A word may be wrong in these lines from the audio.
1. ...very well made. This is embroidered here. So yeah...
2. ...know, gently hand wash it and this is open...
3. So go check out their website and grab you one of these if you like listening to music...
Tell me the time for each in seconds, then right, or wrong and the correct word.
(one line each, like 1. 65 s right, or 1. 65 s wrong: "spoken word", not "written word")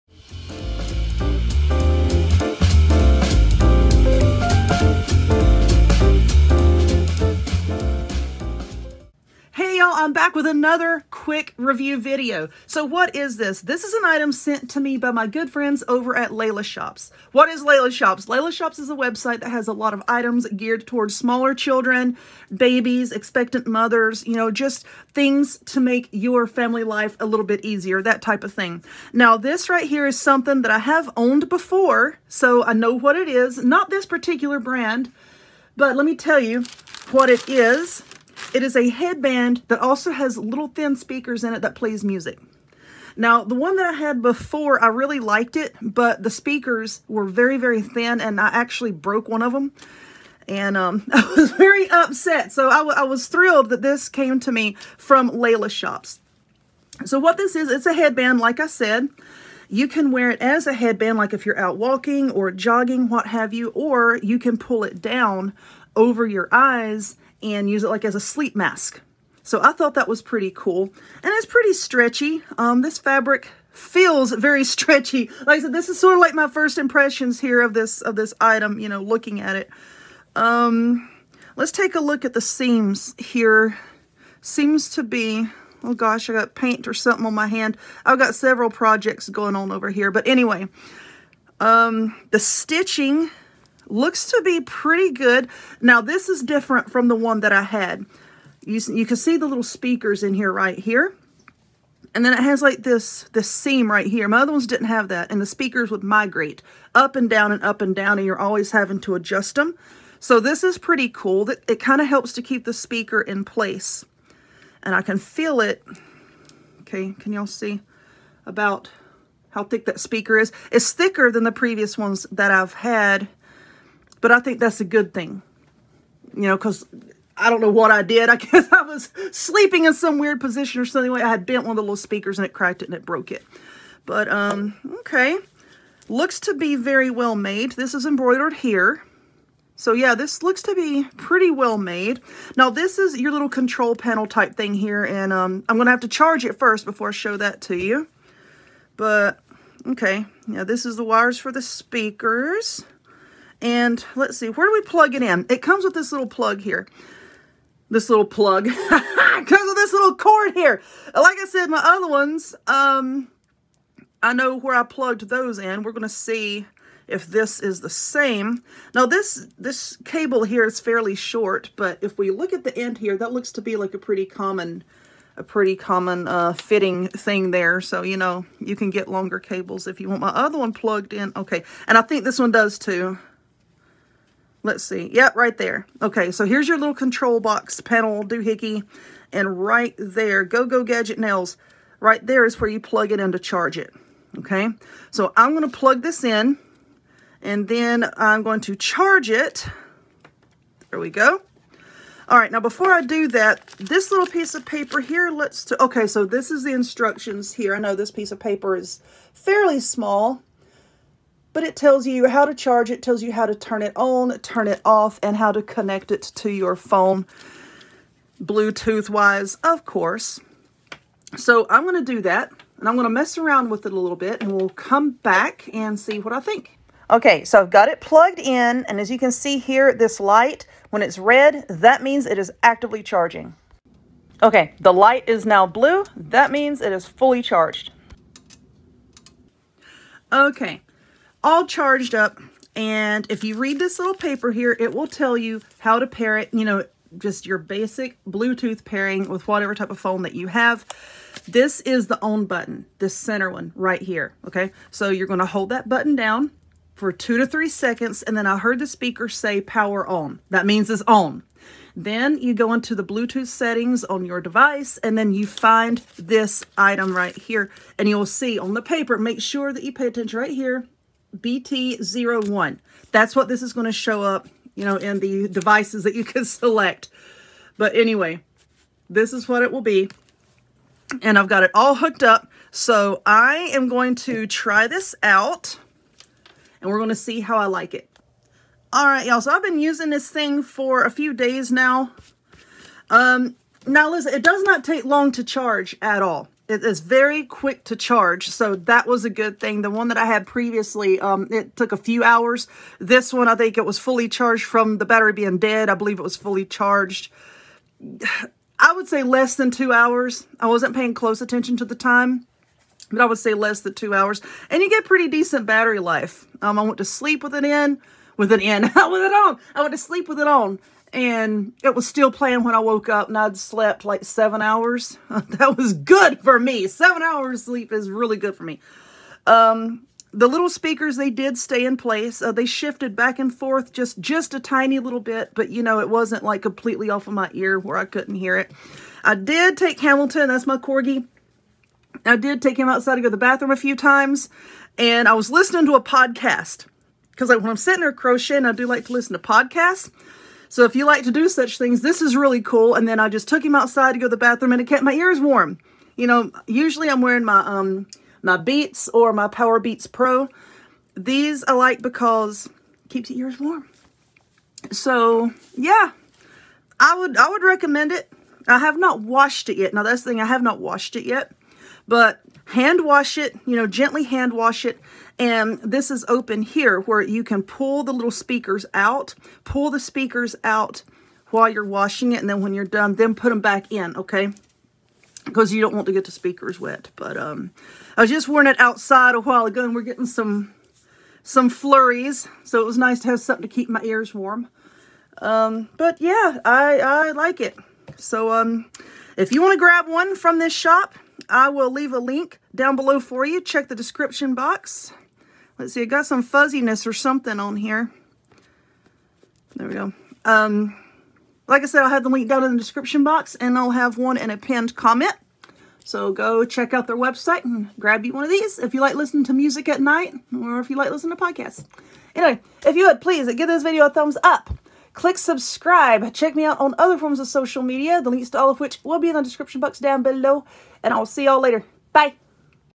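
1. 136 s right
2. 373 s right
3. 416 s right.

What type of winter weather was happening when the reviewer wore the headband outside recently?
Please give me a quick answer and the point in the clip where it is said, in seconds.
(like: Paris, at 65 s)
Flurries, at 391 s.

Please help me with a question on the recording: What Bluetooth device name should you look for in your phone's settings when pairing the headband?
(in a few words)
BT01.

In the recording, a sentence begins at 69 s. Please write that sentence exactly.
So I thought that was pretty cool.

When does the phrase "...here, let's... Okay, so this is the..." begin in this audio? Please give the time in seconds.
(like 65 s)
204 s.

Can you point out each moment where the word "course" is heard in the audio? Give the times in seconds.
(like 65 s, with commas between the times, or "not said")
219 s.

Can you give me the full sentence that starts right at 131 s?
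I had bent one of the little speakers and it cracked it and it broke it.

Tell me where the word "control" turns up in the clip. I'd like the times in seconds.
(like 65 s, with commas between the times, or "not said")
143 s, 186 s.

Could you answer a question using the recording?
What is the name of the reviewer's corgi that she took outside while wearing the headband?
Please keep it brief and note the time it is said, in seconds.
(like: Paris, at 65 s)
Hamilton, at 339 s.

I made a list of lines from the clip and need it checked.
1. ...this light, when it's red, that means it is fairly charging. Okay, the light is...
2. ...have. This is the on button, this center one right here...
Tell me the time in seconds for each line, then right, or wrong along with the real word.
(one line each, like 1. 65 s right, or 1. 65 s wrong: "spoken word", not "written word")
1. 229 s wrong: "actively", not "fairly"
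2. 250 s right.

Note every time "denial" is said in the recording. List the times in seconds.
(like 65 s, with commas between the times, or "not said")
not said.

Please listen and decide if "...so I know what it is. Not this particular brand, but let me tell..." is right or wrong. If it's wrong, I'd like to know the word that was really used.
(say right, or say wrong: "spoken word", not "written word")
right.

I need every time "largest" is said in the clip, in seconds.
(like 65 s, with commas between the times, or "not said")
not said.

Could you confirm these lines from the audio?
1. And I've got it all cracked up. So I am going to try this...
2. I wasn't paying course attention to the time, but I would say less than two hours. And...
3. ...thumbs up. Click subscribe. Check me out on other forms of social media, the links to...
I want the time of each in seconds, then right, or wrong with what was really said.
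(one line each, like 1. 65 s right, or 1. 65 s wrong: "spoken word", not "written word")
1. 281 s wrong: "hooked", not "cracked"
2. 310 s wrong: "close", not "course"
3. 424 s right.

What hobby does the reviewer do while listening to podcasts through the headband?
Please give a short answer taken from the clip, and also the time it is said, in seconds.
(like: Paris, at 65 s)
Crocheting, at 348 s.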